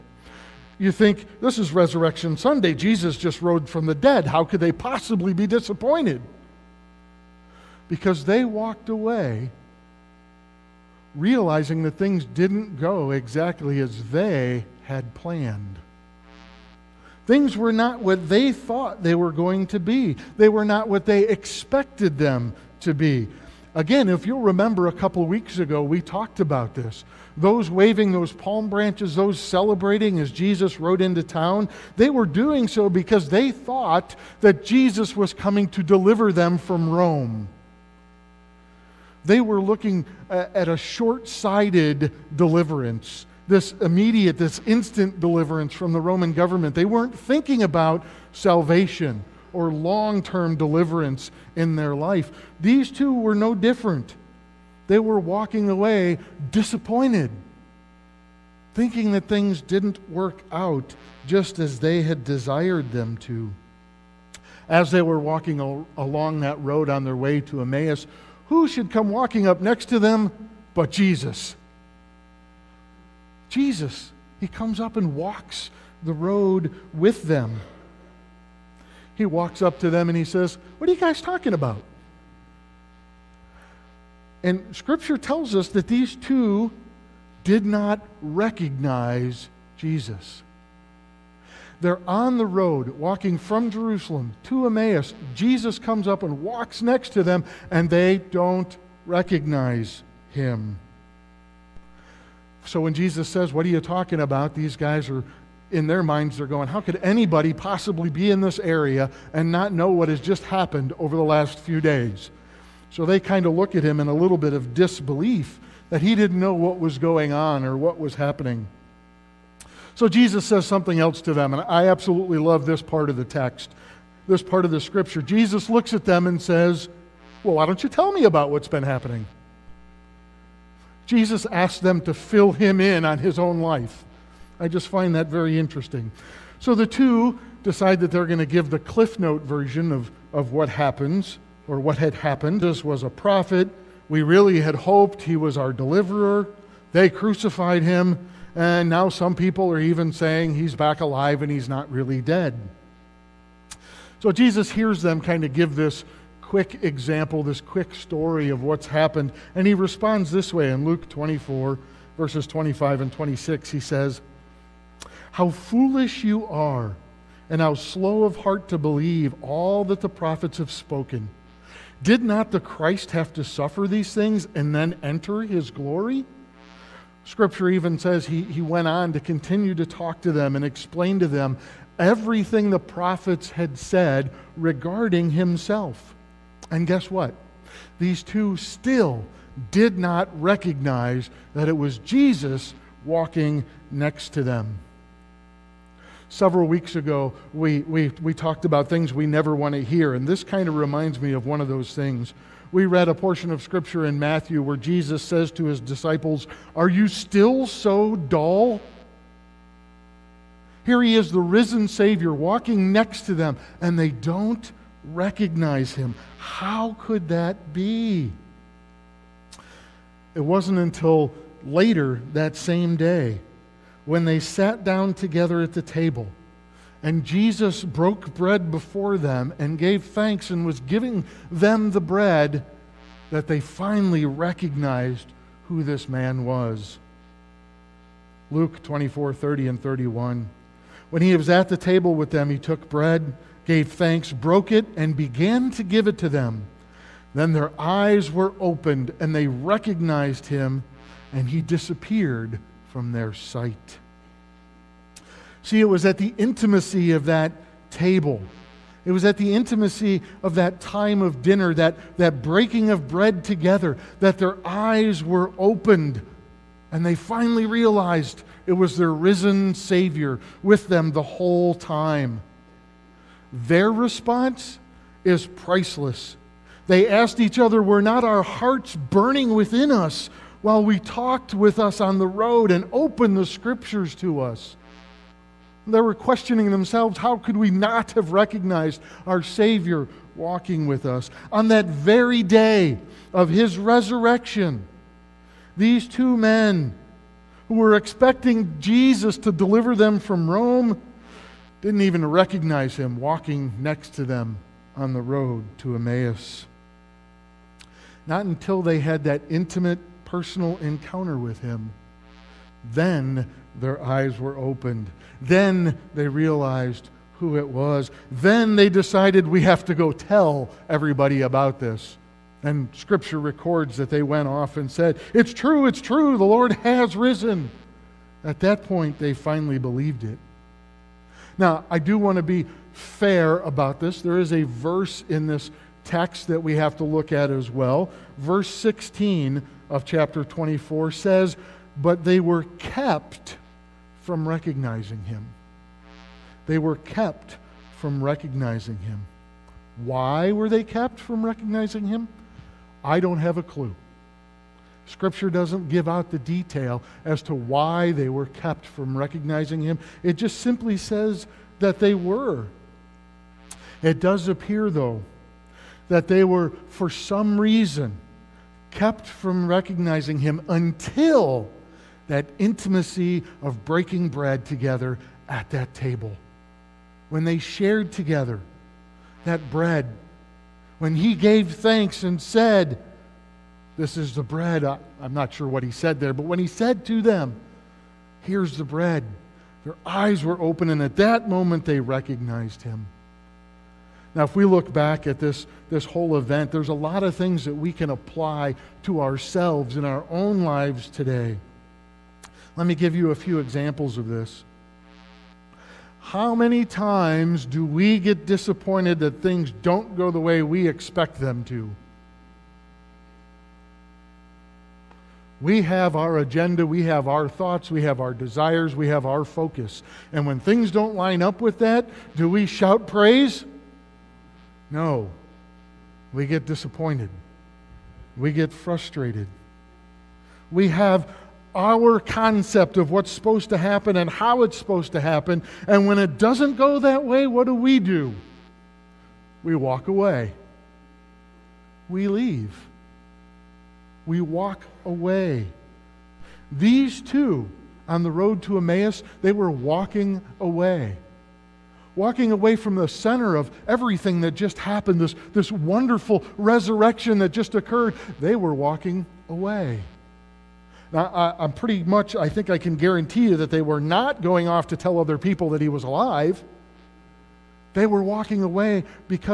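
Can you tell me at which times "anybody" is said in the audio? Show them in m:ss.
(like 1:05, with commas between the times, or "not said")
1:47.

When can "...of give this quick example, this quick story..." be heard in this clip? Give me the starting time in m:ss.
2:35.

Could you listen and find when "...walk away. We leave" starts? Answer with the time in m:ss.
7:19.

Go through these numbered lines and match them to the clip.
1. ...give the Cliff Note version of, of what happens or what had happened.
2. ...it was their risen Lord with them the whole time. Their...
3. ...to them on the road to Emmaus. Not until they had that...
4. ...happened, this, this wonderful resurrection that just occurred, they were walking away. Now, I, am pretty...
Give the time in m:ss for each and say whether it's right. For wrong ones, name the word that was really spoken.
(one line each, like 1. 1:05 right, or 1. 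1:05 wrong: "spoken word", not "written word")
1. 2:18 right
2. 4:28 wrong: "Savior", not "Lord"
3. 5:04 right
4. 7:34 right.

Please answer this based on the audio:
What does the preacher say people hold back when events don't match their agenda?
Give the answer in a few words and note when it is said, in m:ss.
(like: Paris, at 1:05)
praise, at 7:02.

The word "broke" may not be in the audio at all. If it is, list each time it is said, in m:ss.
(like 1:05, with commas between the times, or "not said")
3:47, 4:04.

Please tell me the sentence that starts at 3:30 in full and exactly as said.
Here he is, the risen Savior, walking next to them, and they don't recognize him.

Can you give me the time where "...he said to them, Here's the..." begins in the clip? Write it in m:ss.
6:26.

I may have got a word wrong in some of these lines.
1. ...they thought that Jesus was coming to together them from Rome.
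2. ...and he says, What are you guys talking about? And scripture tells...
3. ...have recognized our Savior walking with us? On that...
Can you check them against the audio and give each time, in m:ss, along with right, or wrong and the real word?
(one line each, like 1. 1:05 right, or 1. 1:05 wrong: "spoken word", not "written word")
1. 0:33 wrong: "deliver", not "together"
2. 1:20 right
3. 4:48 right.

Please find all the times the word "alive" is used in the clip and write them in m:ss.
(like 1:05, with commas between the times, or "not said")
2:31, 7:46.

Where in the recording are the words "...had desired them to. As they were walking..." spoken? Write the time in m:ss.
1:02.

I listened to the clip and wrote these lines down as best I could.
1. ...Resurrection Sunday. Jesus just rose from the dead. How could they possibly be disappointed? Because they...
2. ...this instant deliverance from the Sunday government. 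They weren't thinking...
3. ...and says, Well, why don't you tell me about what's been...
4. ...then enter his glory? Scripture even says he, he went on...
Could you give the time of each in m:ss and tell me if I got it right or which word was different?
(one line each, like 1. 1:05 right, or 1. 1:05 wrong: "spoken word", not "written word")
1. 0:01 right
2. 0:44 wrong: "Roman", not "Sunday"
3. 2:06 right
4. 2:54 right.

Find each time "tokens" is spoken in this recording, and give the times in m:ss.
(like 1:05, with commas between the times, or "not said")
not said.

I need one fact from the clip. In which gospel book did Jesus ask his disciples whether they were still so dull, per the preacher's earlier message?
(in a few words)
Matthew.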